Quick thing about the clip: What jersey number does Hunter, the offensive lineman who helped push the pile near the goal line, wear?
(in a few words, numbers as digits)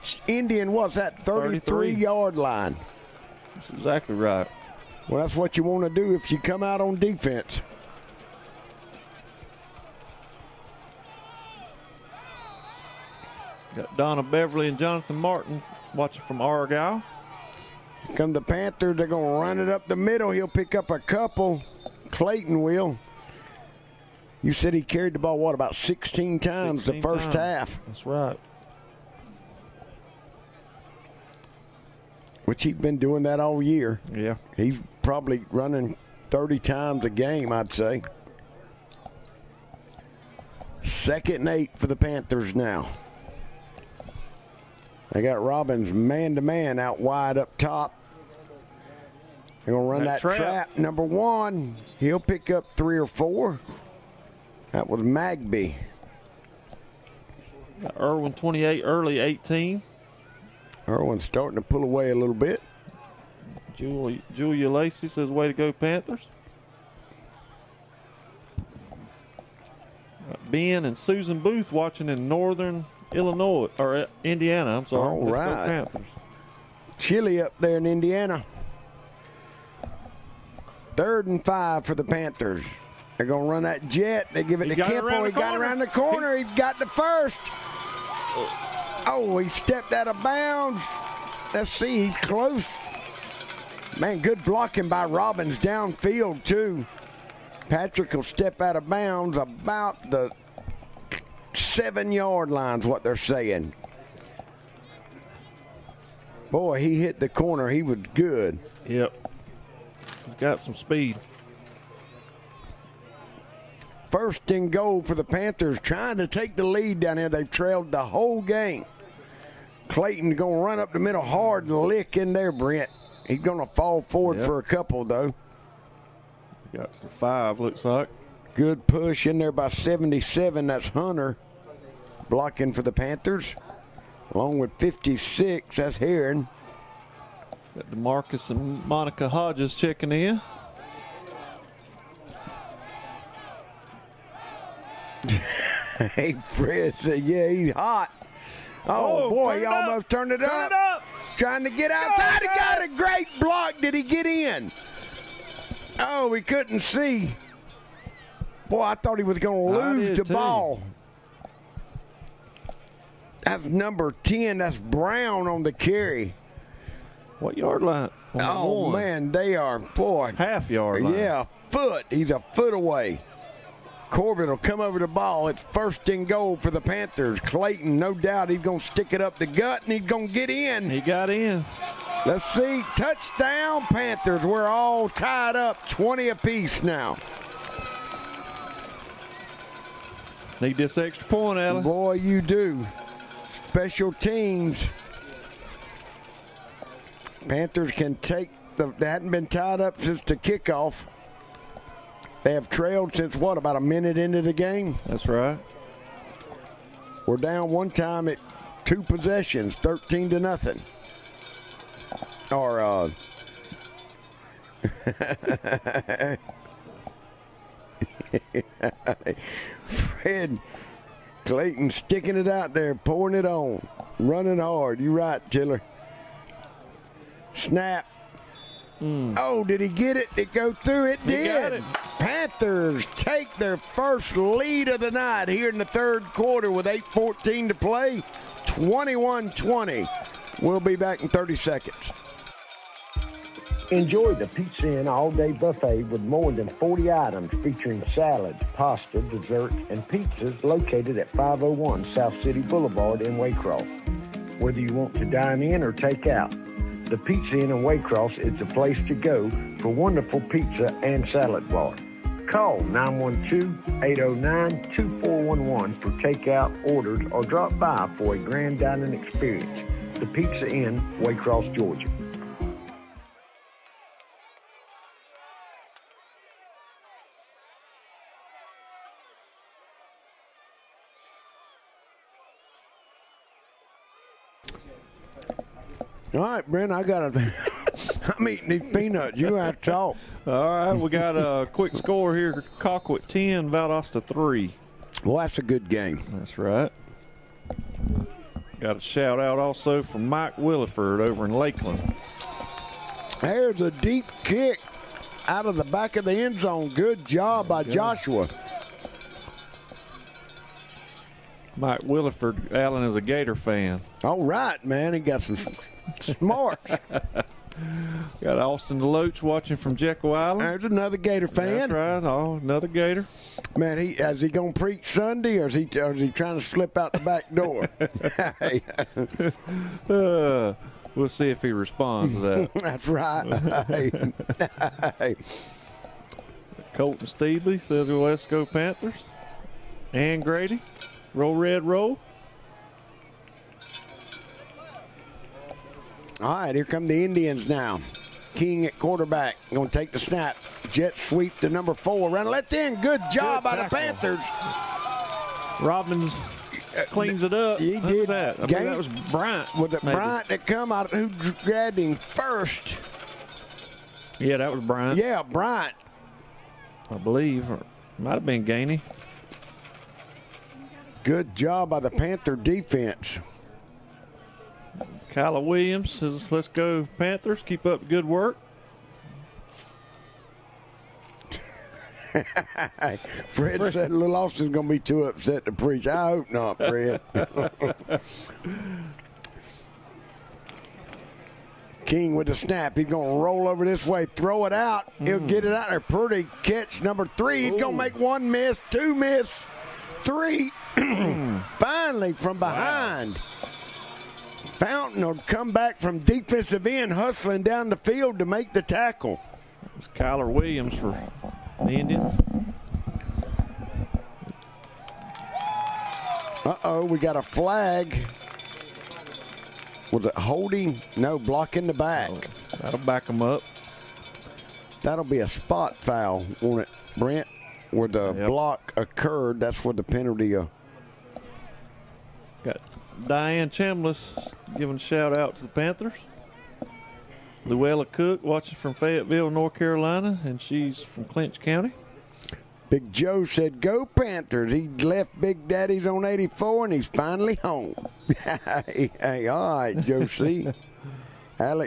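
77.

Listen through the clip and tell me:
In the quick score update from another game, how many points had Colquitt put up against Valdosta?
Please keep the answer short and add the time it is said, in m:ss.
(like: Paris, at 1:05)
10, at 4:52.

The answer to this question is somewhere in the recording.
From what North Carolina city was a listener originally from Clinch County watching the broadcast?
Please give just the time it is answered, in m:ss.
7:18.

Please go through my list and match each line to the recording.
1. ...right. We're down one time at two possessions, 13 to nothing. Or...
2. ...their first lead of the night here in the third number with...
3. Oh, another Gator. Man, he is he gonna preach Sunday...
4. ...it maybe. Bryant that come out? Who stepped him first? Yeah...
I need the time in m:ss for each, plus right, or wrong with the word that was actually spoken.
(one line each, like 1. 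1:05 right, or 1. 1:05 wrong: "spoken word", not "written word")
1. 3:25 right
2. 3:53 wrong: "quarter", not "number"
3. 5:22 right
4. 5:59 wrong: "grabbed", not "stepped".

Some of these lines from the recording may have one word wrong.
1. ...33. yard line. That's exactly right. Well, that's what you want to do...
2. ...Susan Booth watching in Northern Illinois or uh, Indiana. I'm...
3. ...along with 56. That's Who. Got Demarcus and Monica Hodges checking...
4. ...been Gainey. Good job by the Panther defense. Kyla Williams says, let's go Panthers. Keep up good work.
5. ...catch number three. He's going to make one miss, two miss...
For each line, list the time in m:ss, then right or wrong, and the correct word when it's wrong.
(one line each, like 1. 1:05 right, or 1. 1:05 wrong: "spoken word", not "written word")
1. 0:01 right
2. 1:10 right
3. 2:14 wrong: "Heron", not "Who"
4. 6:08 right
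5. 6:36 right.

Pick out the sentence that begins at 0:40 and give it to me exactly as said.
Second and eight for the Panthers now.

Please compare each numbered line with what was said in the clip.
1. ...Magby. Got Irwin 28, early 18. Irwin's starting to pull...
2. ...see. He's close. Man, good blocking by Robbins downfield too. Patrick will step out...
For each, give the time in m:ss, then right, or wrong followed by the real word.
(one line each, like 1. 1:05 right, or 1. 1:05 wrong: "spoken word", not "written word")
1. 0:55 right
2. 1:31 right.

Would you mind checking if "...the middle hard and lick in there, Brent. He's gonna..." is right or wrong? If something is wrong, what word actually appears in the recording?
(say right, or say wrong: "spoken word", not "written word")
right.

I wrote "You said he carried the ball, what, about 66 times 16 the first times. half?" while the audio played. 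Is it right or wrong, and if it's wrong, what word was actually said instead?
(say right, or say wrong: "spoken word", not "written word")
wrong: "16", not "66".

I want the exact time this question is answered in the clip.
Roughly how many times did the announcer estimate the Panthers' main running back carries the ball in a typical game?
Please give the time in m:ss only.
0:36.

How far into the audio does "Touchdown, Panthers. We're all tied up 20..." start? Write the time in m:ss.
3:02.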